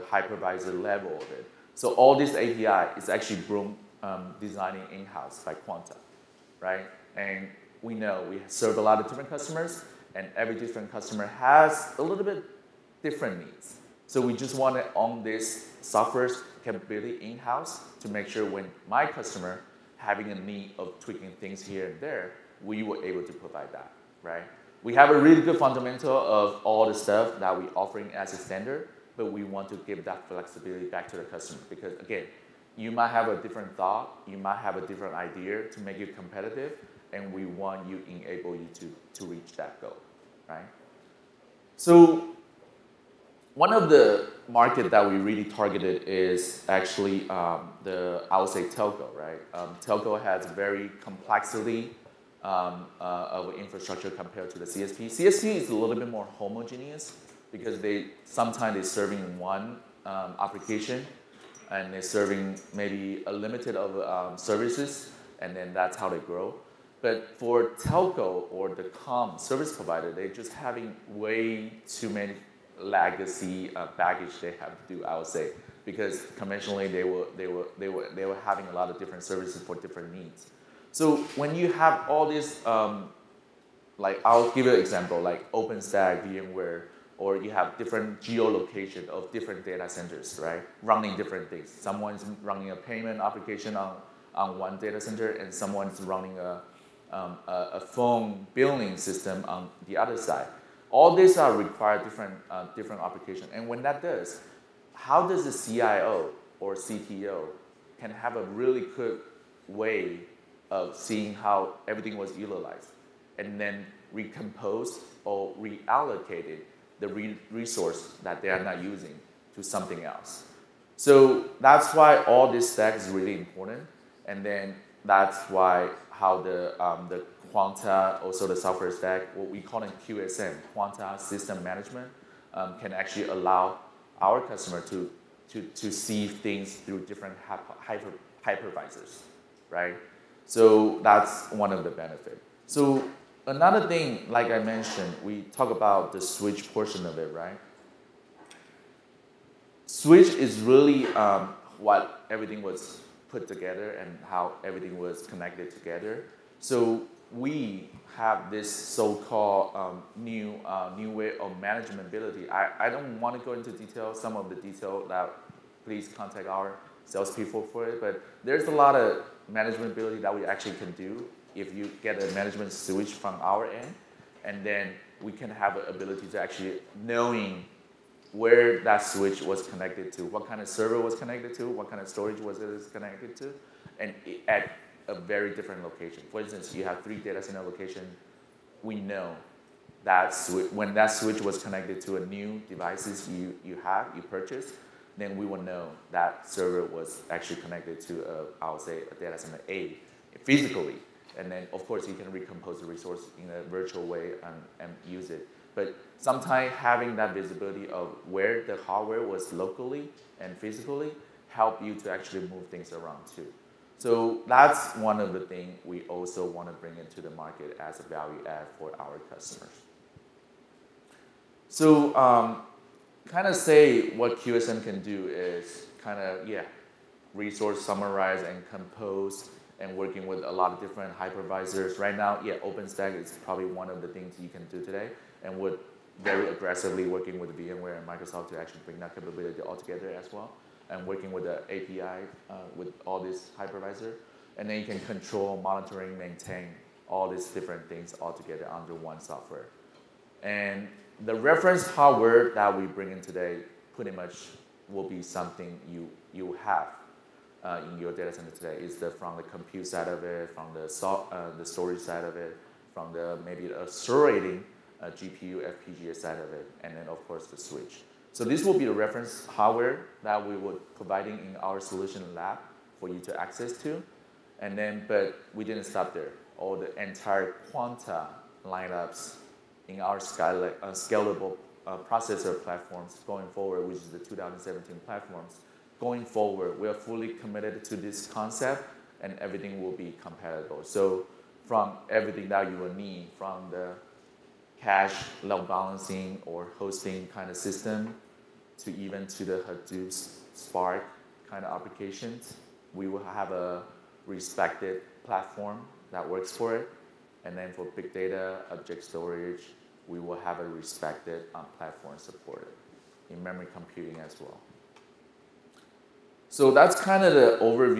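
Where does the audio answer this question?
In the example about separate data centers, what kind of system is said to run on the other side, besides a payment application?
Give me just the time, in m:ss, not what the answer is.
1:37.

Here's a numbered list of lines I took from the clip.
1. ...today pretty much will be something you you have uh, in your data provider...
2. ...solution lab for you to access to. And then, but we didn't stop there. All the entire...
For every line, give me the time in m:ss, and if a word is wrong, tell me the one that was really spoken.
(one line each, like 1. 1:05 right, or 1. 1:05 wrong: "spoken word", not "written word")
1. 4:13 wrong: "center", not "provider"
2. 4:31 right.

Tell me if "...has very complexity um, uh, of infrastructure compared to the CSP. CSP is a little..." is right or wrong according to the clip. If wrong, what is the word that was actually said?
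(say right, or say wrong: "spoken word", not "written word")
right.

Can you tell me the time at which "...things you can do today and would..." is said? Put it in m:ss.
3:54.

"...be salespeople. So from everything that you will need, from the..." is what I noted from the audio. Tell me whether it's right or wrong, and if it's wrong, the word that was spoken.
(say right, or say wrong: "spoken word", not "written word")
wrong: "compatible", not "salespeople".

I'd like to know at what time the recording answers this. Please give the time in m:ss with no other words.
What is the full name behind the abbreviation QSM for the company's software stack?
2:10.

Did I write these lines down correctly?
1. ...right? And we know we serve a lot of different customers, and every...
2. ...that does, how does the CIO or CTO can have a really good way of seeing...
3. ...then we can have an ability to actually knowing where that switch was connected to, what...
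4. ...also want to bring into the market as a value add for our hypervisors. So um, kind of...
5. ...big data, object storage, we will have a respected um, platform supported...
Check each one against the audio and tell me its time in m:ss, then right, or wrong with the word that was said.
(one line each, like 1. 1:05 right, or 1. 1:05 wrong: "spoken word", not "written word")
1. 0:06 right
2. 1:43 right
3. 2:54 right
4. 3:36 wrong: "customers", not "hypervisors"
5. 5:07 right.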